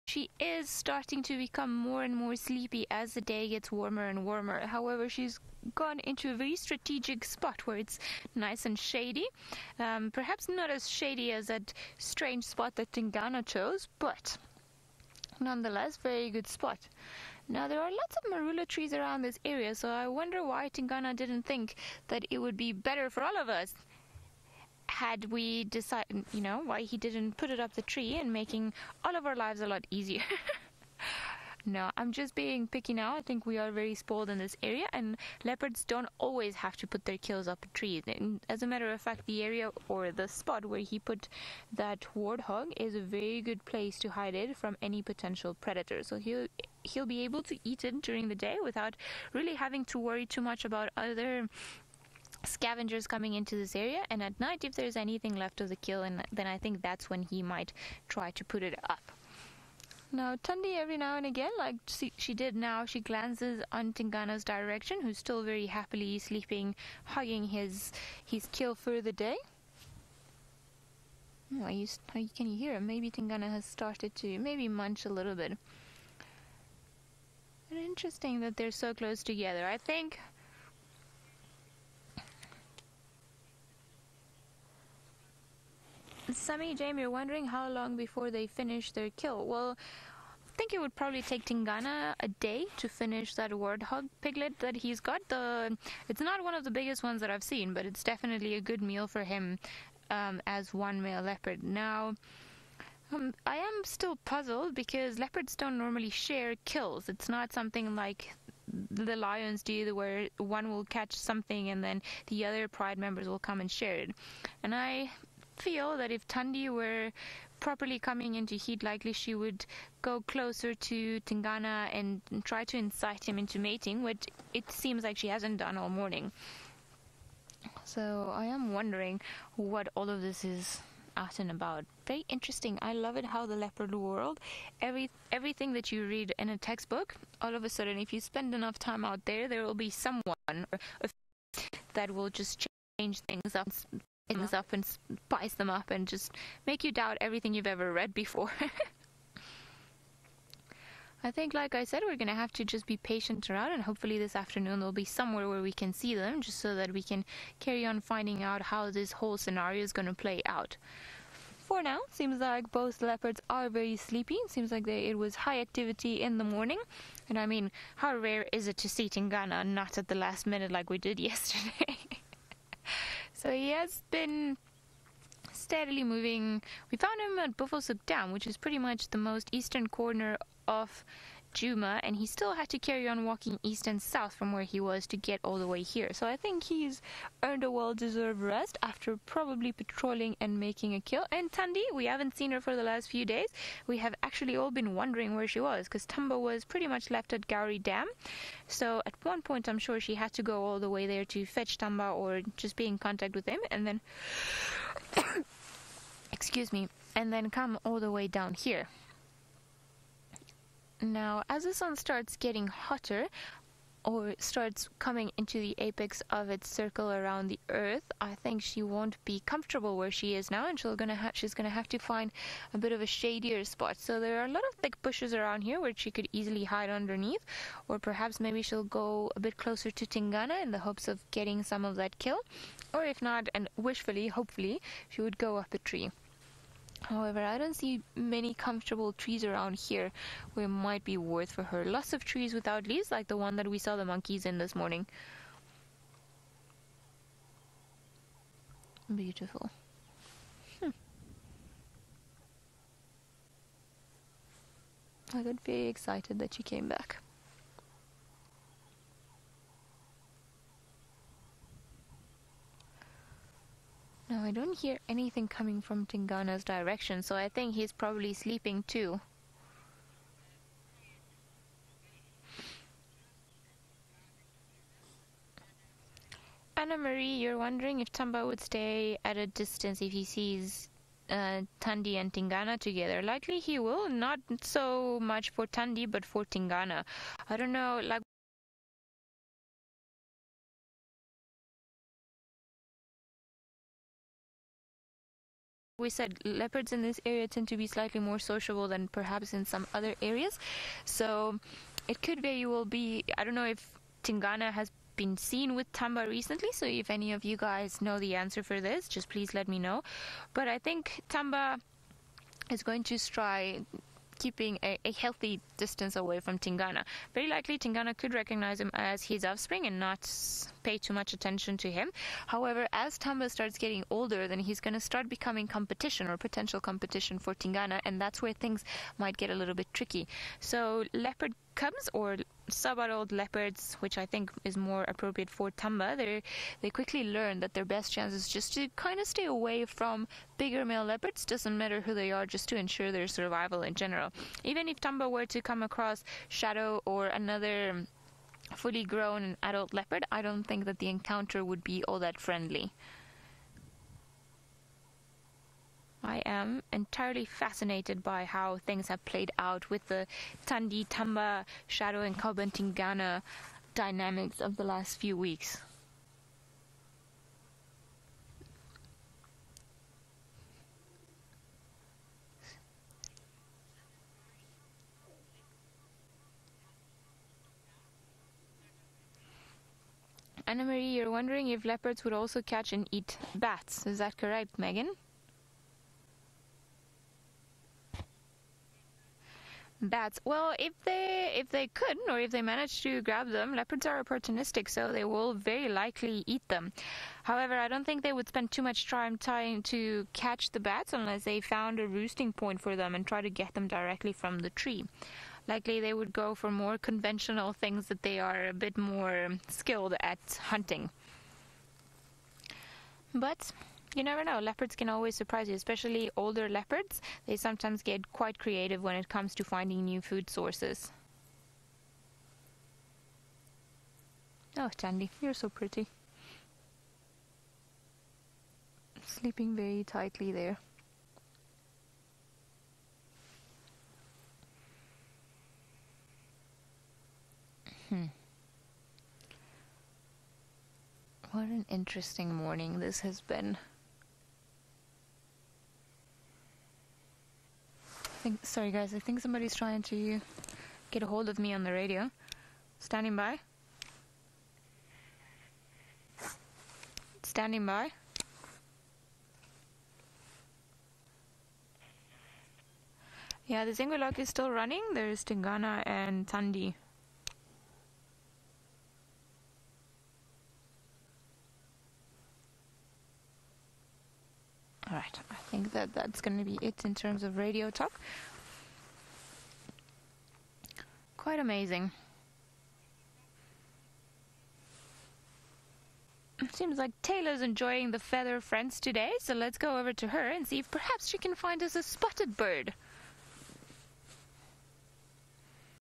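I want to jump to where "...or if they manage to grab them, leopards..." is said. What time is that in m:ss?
6:32.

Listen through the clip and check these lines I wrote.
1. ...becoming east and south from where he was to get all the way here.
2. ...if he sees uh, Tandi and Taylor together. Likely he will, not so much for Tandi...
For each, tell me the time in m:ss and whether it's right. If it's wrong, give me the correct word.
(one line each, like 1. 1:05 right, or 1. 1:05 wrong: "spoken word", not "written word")
1. 3:03 wrong: "walking", not "becoming"
2. 4:40 wrong: "Tingana", not "Taylor".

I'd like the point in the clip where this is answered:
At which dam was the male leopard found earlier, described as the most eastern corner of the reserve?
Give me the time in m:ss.
2:57.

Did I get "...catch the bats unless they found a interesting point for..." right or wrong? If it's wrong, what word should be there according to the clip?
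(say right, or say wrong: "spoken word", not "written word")
wrong: "roosting", not "interesting".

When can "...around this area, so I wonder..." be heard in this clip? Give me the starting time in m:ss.
0:18.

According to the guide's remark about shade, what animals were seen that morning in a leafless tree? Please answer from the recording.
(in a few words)
Monkeys.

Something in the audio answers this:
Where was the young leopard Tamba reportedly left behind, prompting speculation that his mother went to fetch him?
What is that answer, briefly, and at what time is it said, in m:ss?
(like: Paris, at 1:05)
Gowrie Dam, at 3:17.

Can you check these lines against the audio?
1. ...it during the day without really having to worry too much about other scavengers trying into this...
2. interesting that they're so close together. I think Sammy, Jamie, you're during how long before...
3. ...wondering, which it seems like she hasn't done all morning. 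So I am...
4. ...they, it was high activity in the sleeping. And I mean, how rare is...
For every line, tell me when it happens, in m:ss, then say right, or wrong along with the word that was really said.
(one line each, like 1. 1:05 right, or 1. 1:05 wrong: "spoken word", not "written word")
1. 0:47 wrong: "coming", not "trying"
2. 1:17 wrong: "wondering", not "during"
3. 2:03 wrong: "mating", not "wondering"
4. 2:44 wrong: "morning", not "sleeping".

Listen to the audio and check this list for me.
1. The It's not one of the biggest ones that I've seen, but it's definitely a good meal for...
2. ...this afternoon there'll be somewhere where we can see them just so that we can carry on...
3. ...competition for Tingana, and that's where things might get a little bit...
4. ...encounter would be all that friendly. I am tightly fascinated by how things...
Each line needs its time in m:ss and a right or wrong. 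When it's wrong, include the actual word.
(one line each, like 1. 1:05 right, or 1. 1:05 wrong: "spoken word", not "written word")
1. 1:35 right
2. 2:34 right
3. 5:26 right
4. 5:51 wrong: "entirely", not "tightly".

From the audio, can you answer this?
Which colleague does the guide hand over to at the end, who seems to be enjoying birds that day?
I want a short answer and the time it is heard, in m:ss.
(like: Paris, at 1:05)
Taylor, at 8:07.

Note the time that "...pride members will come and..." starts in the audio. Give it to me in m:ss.
1:52.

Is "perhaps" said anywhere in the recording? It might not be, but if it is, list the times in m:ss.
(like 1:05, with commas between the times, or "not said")
0:10, 3:47, 4:59, 8:10.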